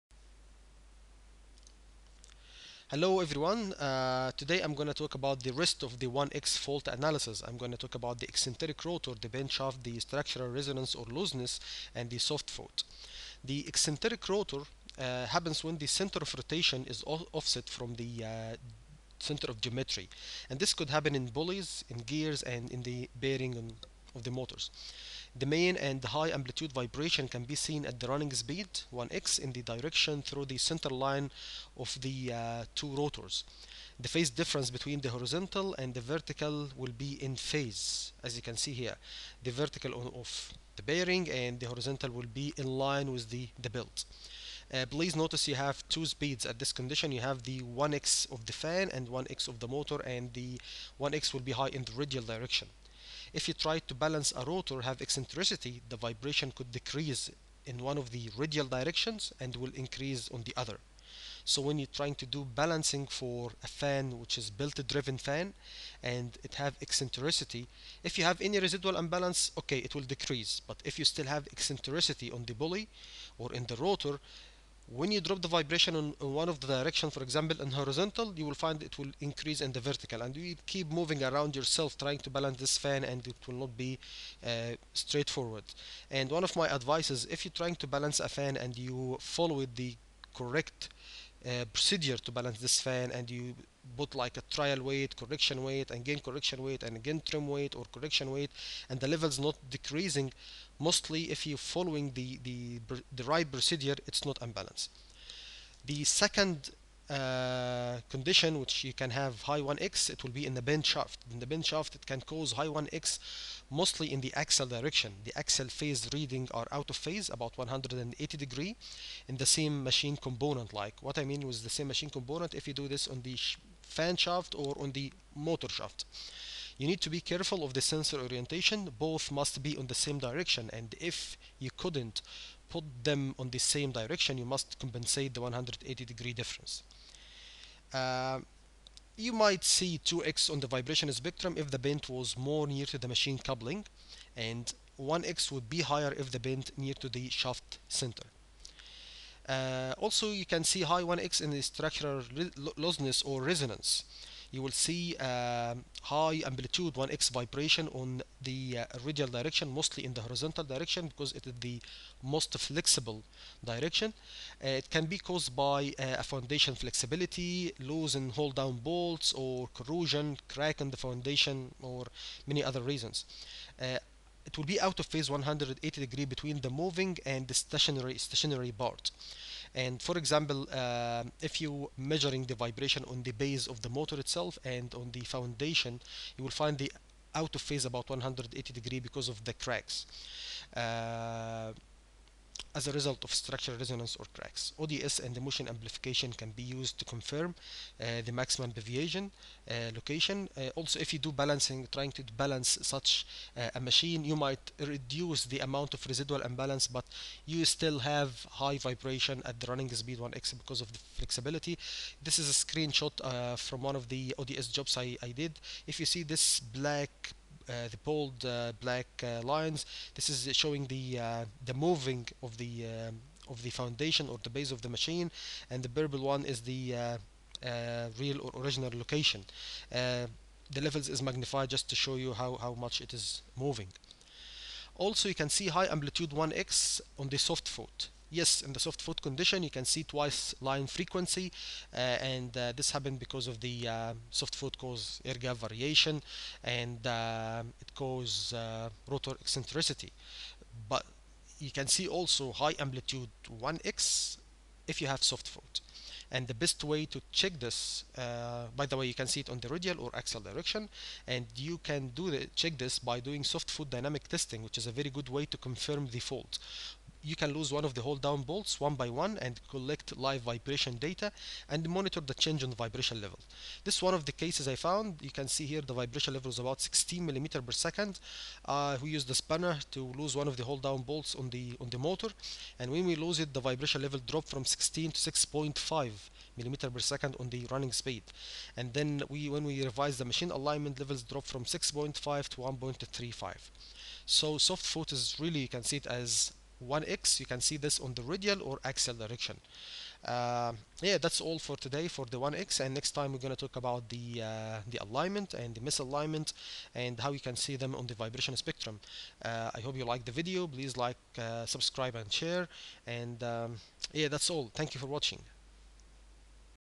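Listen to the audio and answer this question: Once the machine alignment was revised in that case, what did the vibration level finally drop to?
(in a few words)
1.35.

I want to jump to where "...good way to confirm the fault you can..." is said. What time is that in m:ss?
4:25.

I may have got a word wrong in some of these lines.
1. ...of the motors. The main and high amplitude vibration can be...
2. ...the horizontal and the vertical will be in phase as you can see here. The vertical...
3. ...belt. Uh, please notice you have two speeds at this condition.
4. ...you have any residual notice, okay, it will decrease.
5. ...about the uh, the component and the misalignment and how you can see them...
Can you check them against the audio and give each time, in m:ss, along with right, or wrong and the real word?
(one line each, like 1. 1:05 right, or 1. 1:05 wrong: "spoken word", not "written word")
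1. 0:24 right
2. 0:34 right
3. 0:43 right
4. 1:08 wrong: "imbalance", not "notice"
5. 5:03 wrong: "alignment", not "component".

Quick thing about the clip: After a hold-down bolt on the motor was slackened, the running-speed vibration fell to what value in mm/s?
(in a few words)
6.5.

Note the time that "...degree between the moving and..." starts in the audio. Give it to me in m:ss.
2:56.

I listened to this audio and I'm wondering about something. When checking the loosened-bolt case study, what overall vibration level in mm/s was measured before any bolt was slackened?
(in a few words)
16.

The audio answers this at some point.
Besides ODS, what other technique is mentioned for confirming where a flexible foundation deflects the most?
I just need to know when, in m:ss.
3:15.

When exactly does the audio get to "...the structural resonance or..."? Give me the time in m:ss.
0:09.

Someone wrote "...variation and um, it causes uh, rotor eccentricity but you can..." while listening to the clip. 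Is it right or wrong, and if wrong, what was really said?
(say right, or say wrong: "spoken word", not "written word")
right.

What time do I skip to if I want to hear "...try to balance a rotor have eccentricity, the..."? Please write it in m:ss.
0:53.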